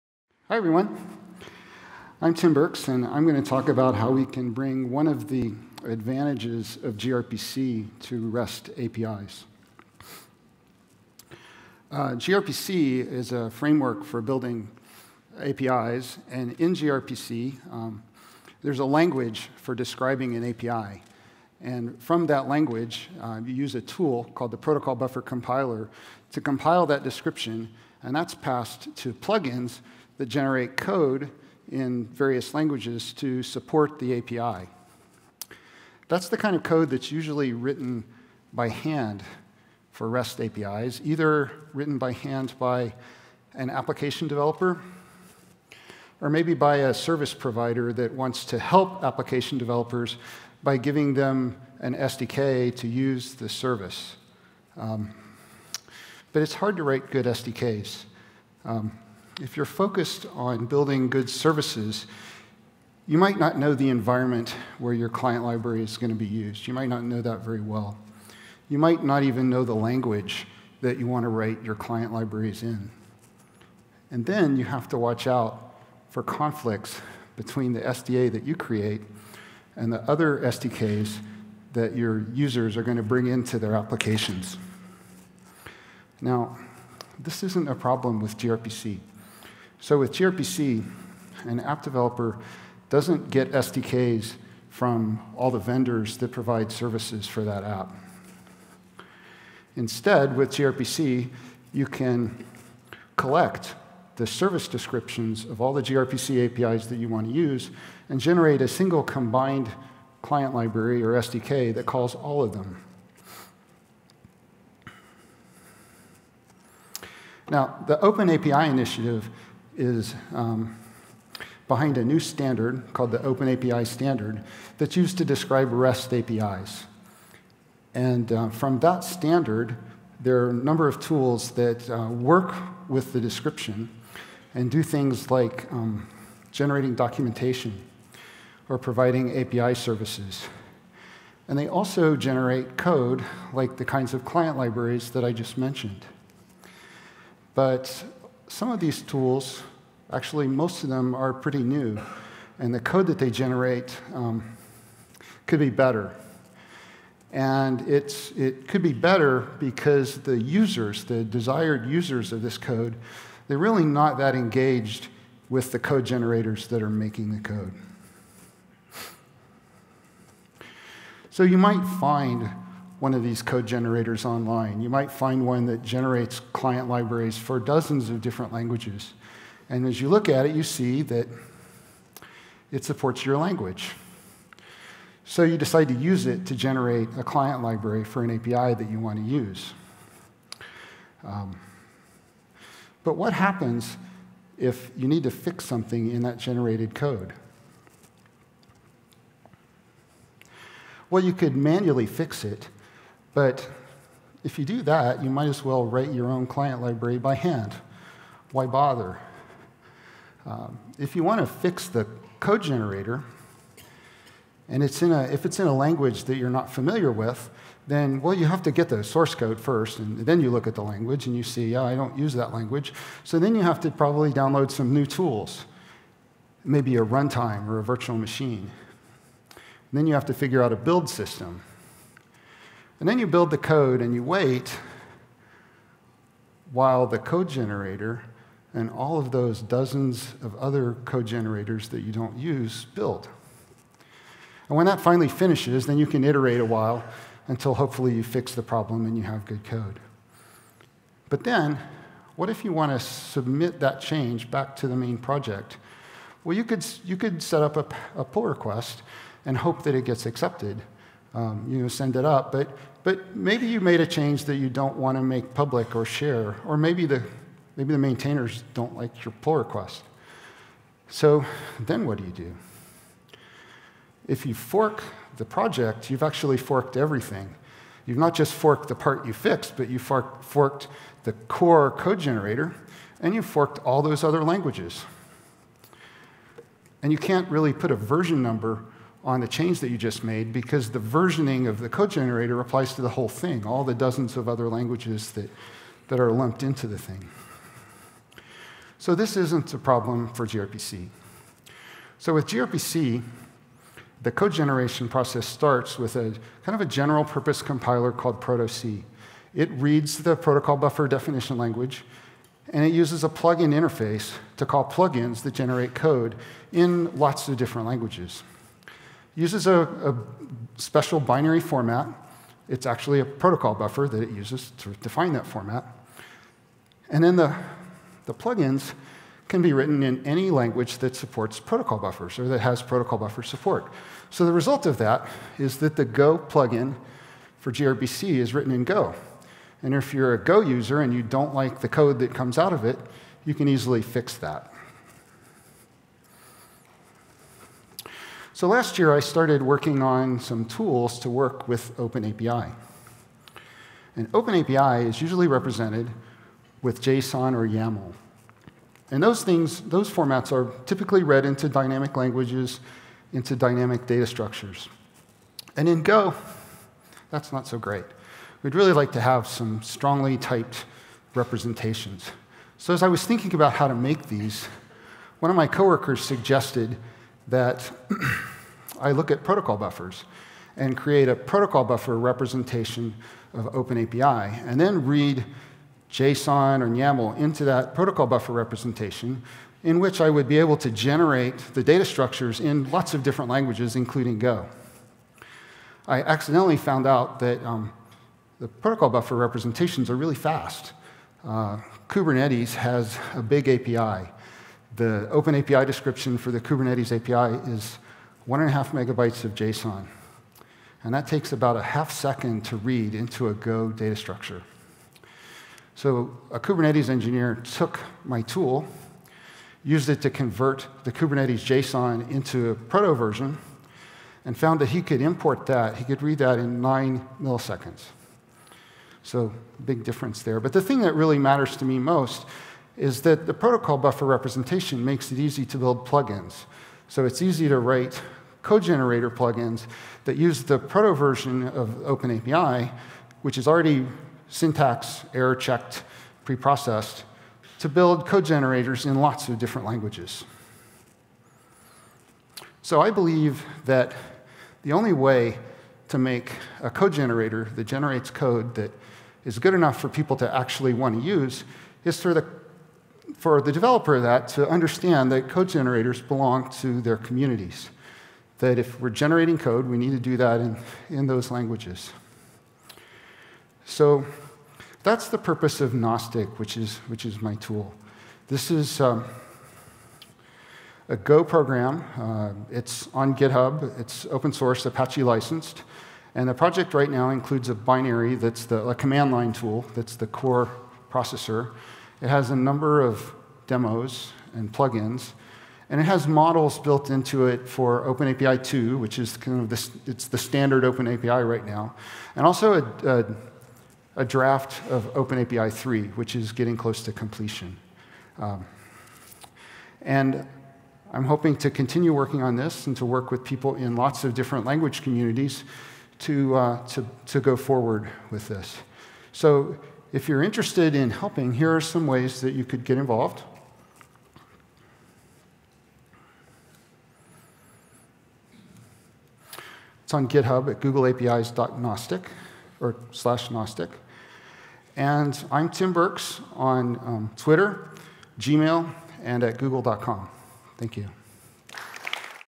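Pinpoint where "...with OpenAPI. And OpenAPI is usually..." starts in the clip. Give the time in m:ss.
5:51.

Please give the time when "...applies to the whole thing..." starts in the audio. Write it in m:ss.
4:52.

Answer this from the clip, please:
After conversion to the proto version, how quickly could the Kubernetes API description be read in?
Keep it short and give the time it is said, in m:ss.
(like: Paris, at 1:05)
9 milliseconds, at 7:06.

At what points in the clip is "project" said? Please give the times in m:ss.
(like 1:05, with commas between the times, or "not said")
4:15, 4:35, 8:06.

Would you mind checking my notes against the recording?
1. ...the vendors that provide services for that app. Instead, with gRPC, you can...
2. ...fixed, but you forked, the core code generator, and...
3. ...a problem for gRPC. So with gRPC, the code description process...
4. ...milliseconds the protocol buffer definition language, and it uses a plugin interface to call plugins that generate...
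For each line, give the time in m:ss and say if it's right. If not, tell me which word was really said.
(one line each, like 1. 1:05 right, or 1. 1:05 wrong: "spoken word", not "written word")
1. 1:35 right
2. 4:39 right
3. 4:59 wrong: "generation", not "description"
4. 5:09 wrong: "reads", not "milliseconds".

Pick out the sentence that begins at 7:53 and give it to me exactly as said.
So that's the purpose of Gnostic, which is, which is my tool.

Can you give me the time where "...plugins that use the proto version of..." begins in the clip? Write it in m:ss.
7:19.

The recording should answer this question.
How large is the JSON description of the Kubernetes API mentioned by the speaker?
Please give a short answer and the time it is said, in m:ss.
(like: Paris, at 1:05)
1.5 megabytes, at 6:48.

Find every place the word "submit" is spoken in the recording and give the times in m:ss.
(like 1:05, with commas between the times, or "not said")
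4:12.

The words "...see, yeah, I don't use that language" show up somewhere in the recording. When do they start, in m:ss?
3:41.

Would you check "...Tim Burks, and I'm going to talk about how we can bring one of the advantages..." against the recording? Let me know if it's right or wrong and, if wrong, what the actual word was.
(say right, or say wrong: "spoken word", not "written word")
right.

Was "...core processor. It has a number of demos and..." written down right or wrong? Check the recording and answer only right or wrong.
right.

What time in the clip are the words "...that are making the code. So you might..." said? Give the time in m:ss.
2:46.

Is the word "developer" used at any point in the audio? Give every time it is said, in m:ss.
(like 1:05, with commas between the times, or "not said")
0:44, 0:49, 1:31, 7:43.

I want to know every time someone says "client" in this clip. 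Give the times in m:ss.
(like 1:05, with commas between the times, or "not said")
1:05, 1:11, 1:50, 2:24, 2:56, 3:07, 3:26.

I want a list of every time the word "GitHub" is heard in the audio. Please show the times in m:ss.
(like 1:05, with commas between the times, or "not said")
8:03, 8:50.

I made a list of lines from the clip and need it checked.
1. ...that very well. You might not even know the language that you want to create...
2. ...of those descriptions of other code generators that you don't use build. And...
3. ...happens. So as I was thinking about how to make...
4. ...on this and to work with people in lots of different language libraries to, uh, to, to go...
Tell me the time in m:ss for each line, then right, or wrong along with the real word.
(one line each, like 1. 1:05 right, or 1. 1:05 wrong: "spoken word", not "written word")
1. 1:07 wrong: "write", not "create"
2. 3:59 wrong: "dozens", not "descriptions"
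3. 6:11 wrong: "representations", not "happens"
4. 8:32 wrong: "communities", not "libraries".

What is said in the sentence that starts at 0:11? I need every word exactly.
Uh, gRPC is a framework for building APIs, and in gRPC, um, there's a language for describing an API.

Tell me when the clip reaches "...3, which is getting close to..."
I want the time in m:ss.
8:25.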